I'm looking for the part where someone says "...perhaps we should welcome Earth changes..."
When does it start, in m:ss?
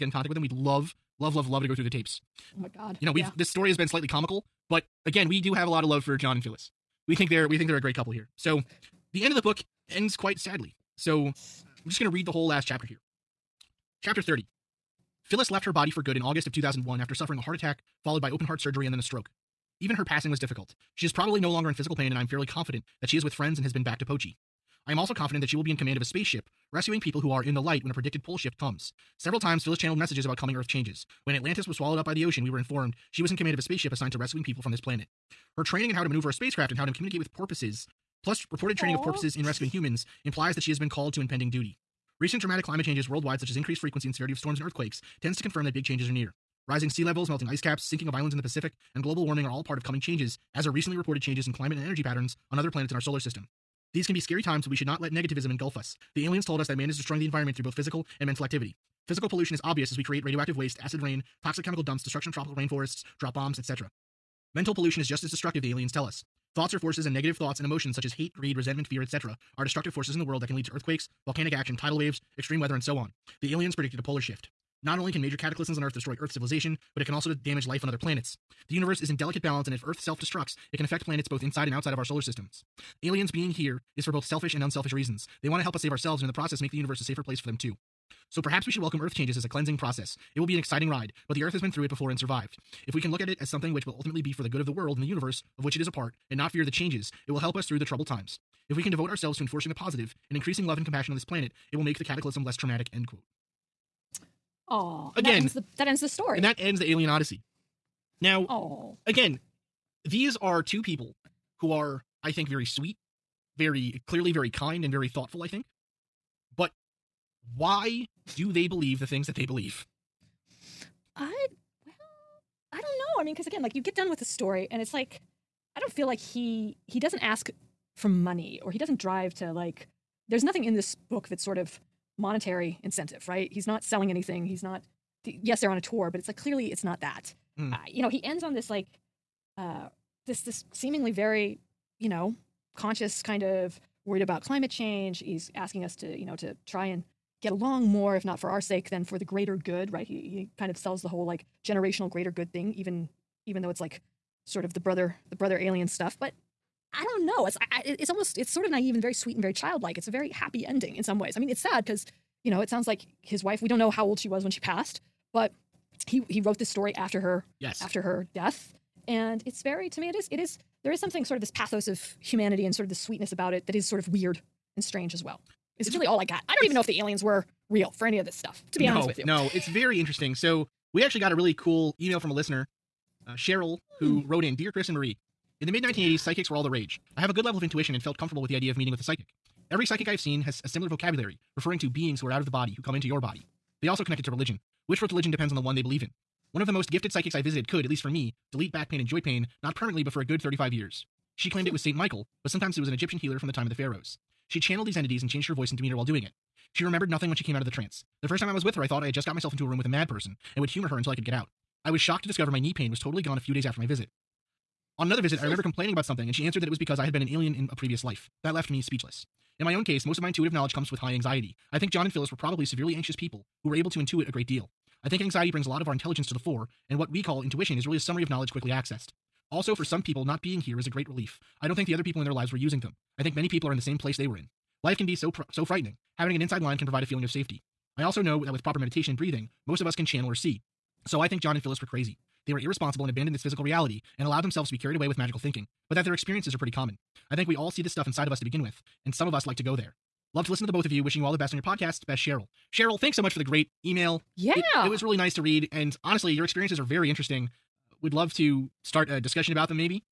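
1:28.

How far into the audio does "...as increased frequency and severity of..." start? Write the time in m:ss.
0:43.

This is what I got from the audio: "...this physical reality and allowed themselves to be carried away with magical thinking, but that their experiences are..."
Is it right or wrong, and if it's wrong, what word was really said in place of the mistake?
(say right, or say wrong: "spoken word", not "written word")
right.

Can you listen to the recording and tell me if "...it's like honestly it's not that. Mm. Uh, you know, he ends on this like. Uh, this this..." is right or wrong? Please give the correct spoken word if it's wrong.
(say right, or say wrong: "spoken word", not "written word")
wrong: "clearly", not "honestly".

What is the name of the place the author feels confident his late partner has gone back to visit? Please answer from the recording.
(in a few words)
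Pochi.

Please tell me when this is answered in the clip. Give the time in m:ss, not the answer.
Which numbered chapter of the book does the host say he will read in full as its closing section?
0:14.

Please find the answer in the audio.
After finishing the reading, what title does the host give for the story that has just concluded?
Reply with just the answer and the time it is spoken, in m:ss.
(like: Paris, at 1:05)
Alien Odyssey, at 1:46.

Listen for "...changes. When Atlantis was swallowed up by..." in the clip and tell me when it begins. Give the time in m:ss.
0:30.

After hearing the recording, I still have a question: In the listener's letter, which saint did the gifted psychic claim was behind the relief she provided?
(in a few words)
Saint Michael.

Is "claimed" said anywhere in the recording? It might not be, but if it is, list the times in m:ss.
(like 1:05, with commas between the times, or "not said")
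3:21.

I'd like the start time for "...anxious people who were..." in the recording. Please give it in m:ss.
3:42.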